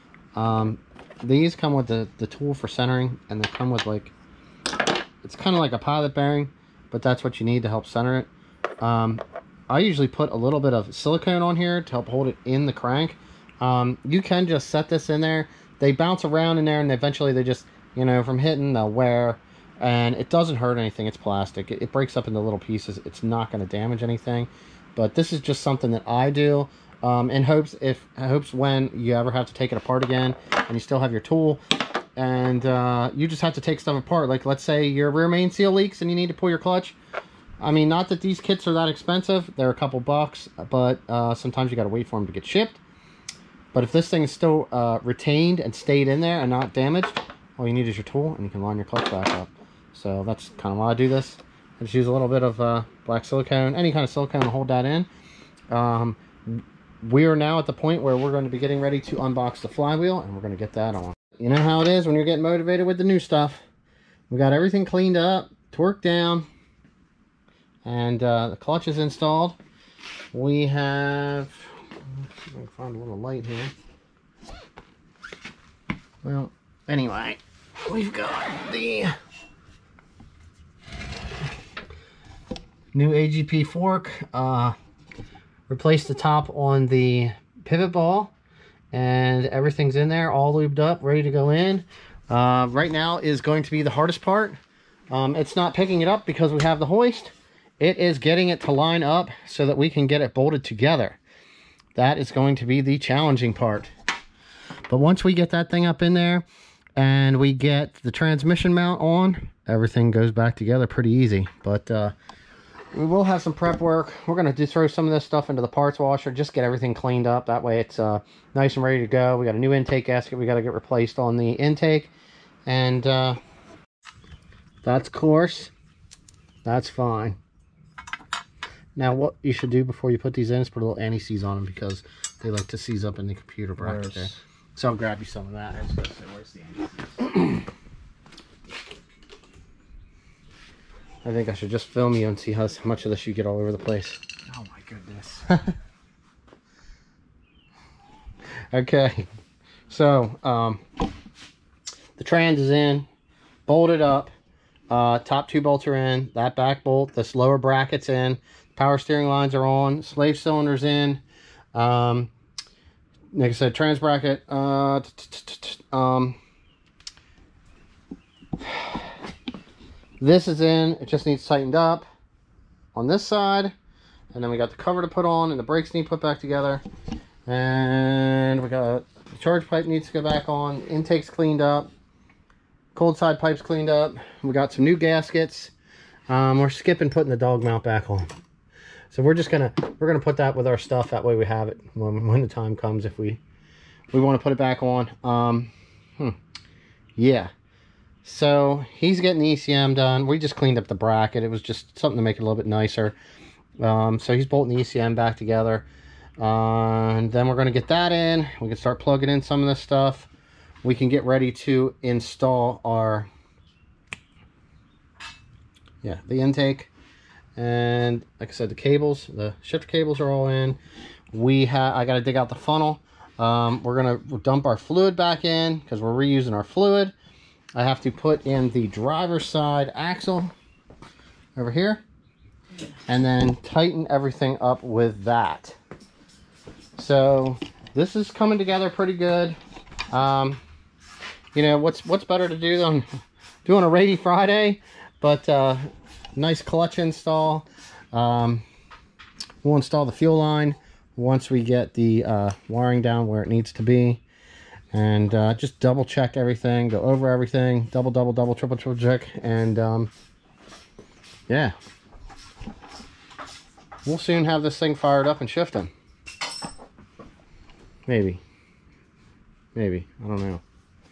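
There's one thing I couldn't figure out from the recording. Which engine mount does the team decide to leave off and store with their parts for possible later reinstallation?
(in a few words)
dog mount.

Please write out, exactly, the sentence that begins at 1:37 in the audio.
It is getting it to line up so that we can get it bolted together.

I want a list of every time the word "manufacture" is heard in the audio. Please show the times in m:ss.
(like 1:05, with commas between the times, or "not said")
not said.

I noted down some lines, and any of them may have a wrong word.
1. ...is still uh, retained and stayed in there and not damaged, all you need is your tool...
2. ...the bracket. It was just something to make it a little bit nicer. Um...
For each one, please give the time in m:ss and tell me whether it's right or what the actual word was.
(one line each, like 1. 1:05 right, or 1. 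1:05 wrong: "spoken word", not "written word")
1. 0:44 right
2. 3:20 right.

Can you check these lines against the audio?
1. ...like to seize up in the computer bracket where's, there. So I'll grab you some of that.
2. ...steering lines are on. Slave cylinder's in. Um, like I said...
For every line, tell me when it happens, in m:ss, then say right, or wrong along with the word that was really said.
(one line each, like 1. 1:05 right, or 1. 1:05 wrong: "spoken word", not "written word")
1. 2:12 right
2. 2:38 right.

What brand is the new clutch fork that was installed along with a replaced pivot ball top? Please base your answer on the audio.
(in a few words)
AGP.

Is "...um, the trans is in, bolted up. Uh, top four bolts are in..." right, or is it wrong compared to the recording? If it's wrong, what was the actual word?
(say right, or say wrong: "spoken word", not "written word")
wrong: "two", not "four".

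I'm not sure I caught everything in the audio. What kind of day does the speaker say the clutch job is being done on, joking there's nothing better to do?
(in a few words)
rainy Friday.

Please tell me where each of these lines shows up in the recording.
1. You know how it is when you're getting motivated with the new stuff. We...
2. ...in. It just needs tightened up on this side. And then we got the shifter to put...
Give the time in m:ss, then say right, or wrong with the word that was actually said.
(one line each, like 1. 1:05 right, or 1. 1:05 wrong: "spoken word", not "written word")
1. 1:01 right
2. 2:50 wrong: "cover", not "shifter".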